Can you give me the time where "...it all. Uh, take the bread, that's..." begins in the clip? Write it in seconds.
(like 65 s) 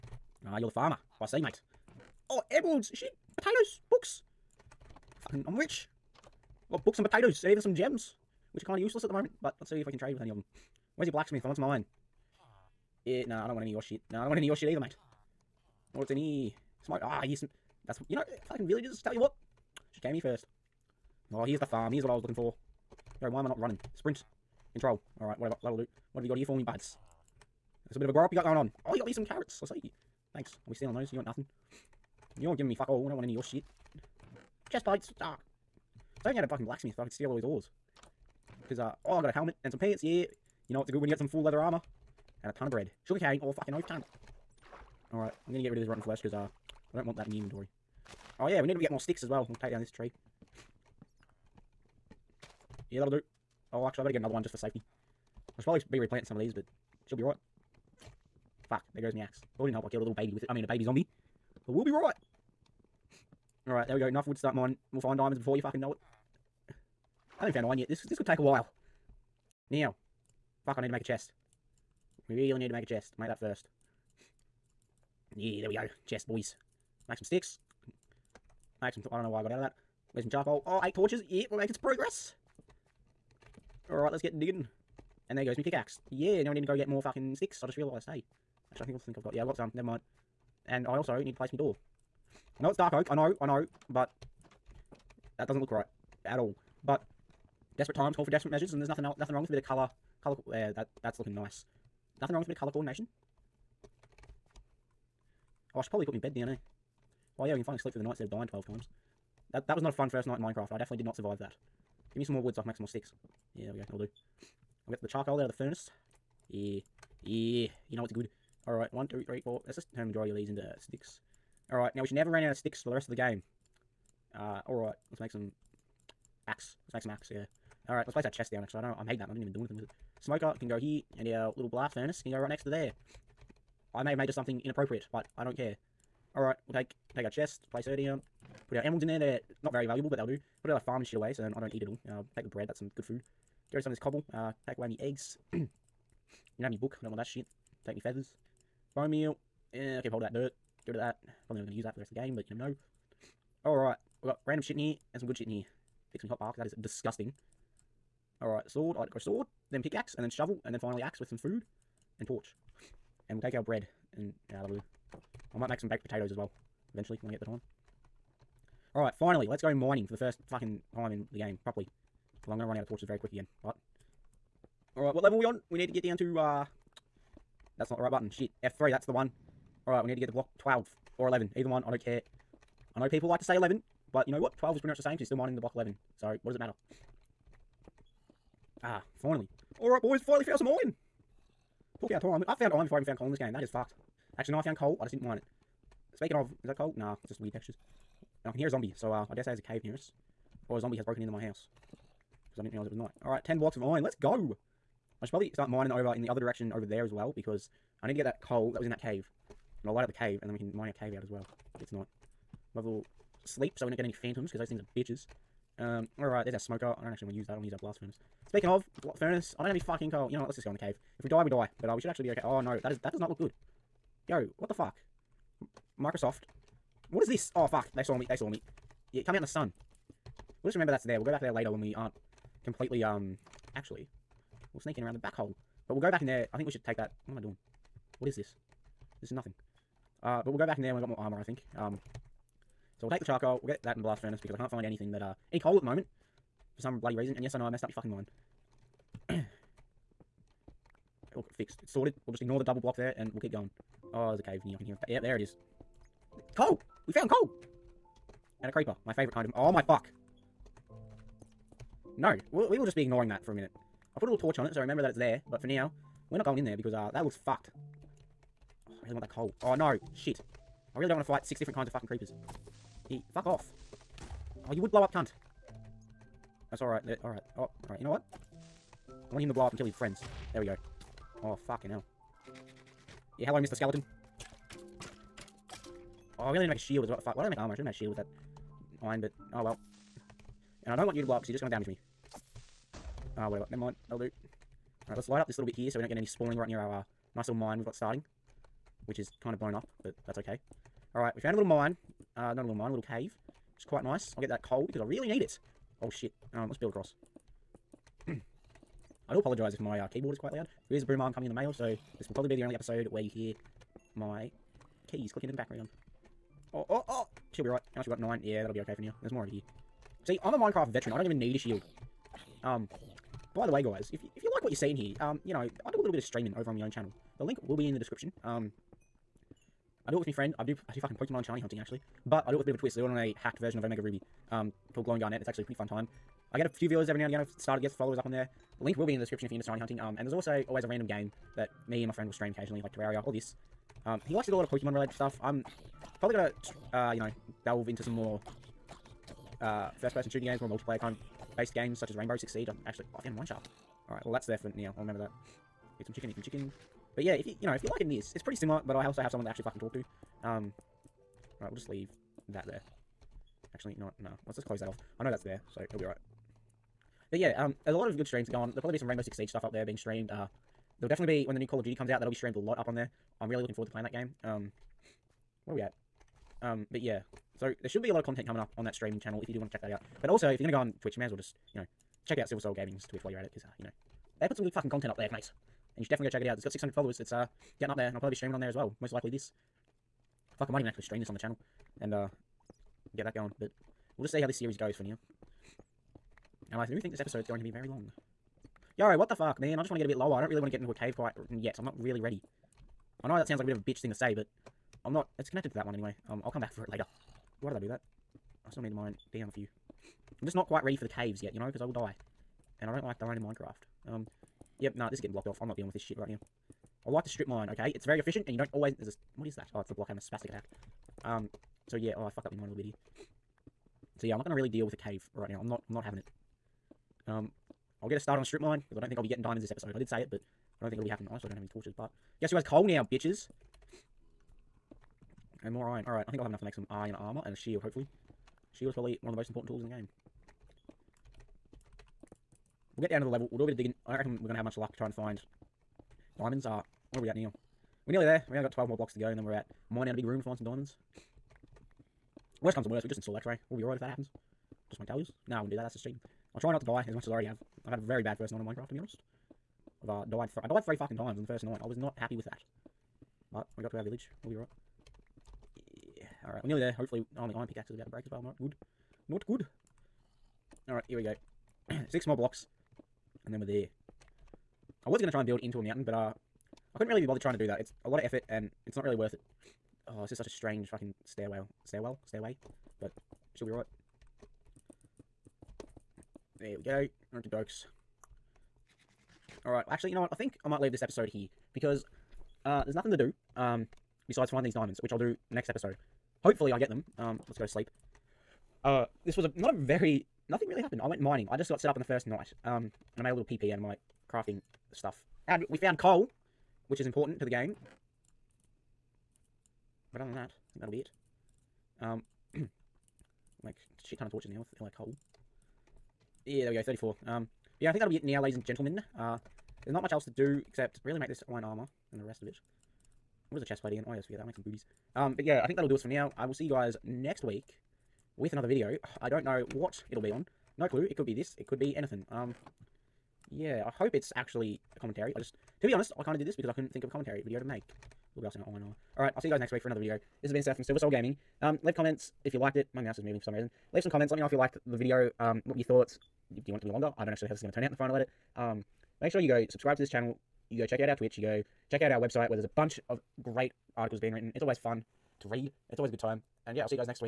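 141 s.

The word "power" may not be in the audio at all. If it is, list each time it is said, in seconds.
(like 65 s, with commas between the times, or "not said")
not said.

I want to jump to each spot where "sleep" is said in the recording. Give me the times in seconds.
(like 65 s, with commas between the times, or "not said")
107 s, 213 s, 497 s.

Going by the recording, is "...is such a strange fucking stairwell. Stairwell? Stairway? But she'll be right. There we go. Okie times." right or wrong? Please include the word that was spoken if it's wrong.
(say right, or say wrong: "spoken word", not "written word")
wrong: "dokes", not "times".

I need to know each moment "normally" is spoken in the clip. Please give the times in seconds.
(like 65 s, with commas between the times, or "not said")
not said.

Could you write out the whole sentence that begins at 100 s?
Color uh, that that's looking nice.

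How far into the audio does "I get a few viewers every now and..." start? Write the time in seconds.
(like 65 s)
336 s.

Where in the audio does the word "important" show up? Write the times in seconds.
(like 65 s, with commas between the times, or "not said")
439 s, 507 s.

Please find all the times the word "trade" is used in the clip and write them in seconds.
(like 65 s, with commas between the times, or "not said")
9 s.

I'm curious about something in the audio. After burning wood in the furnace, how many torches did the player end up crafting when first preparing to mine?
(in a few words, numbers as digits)
8.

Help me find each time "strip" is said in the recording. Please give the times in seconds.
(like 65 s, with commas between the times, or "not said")
417 s, 428 s.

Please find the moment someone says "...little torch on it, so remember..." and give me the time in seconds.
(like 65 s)
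264 s.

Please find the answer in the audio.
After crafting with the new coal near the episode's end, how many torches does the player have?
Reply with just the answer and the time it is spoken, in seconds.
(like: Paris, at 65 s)
34, at 516 s.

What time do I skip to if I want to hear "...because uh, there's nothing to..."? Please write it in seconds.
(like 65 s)
491 s.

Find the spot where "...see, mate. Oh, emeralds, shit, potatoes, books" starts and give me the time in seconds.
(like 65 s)
1 s.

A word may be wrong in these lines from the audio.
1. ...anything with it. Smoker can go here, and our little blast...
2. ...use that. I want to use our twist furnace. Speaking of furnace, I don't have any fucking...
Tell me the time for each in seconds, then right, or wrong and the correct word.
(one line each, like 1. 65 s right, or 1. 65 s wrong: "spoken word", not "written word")
1. 129 s right
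2. 217 s wrong: "blast", not "twist".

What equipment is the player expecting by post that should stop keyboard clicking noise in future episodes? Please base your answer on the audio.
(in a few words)
Boom arm.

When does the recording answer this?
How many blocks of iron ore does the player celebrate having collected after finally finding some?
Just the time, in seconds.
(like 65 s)
203 s.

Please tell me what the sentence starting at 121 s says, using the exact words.
Alright, now we should never run out of sticks for the rest of the game.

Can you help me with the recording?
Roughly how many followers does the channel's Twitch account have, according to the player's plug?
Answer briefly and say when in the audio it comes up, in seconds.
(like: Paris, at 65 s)
600, at 386 s.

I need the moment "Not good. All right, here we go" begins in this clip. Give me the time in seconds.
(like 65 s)
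469 s.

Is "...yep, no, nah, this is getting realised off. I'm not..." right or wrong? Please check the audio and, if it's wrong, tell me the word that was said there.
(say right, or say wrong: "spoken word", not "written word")
wrong: "blocked", not "realised".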